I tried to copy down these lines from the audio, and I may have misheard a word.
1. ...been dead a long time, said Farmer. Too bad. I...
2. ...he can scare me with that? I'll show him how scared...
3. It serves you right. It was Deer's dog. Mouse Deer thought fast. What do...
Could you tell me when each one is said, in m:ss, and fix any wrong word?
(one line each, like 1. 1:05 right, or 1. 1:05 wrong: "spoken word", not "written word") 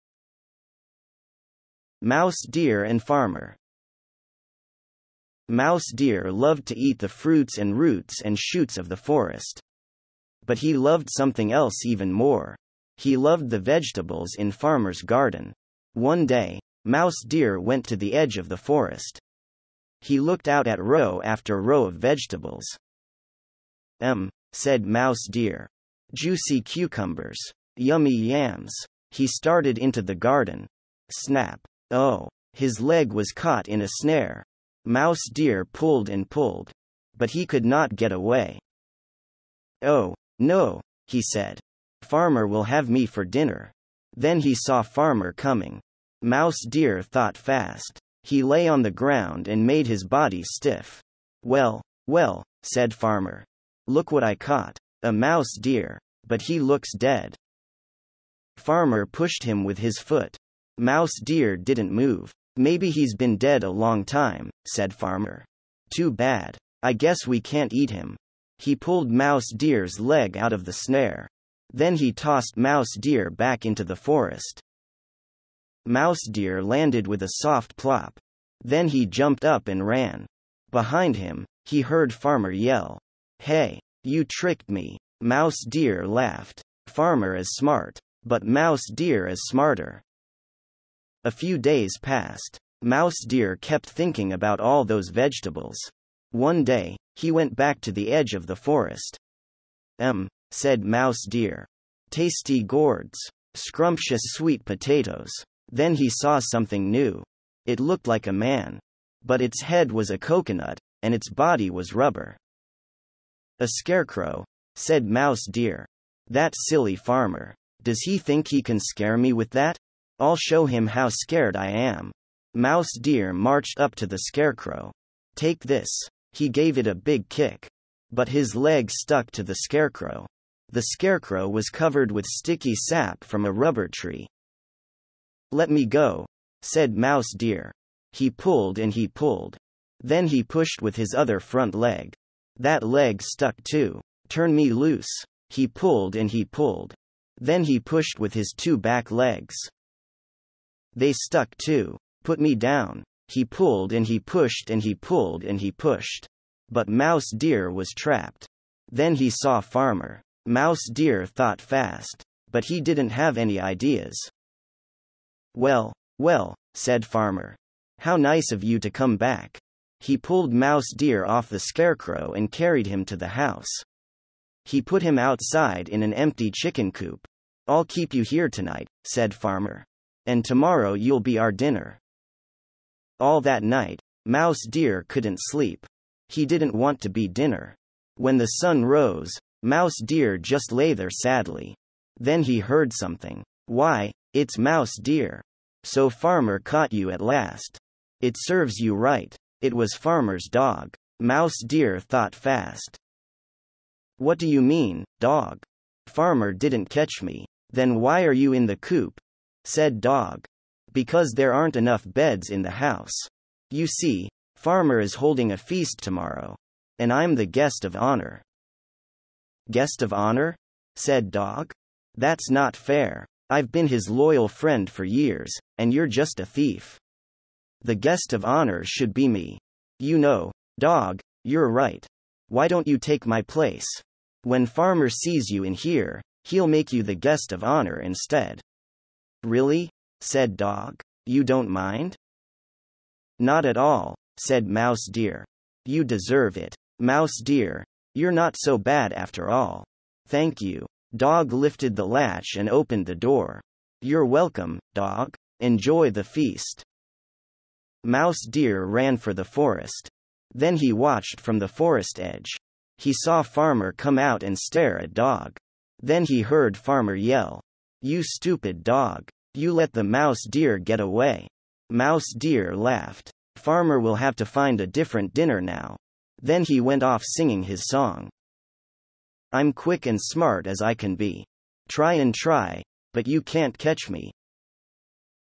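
1. 1:03 right
2. 1:58 right
3. 3:18 wrong: "Farmer", not "Deer".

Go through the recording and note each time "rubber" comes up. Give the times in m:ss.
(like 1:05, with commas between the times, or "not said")
1:51, 2:13.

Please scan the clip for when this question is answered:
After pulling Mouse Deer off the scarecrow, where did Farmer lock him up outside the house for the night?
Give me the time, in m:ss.
2:56.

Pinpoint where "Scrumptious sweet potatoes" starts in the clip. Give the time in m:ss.
1:43.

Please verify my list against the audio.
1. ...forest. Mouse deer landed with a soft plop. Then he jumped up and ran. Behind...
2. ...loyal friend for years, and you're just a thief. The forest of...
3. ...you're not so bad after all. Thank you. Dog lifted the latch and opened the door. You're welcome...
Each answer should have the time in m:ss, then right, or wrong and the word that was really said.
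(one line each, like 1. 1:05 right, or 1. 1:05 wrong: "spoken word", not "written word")
1. 1:13 right
2. 3:44 wrong: "guest", not "forest"
3. 4:08 right.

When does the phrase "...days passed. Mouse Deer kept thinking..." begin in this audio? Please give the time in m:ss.
1:31.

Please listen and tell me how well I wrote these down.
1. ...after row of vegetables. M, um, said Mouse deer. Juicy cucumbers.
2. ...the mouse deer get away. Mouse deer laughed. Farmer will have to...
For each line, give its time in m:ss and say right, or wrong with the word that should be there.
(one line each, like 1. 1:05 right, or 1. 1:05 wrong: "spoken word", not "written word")
1. 0:21 right
2. 4:29 right.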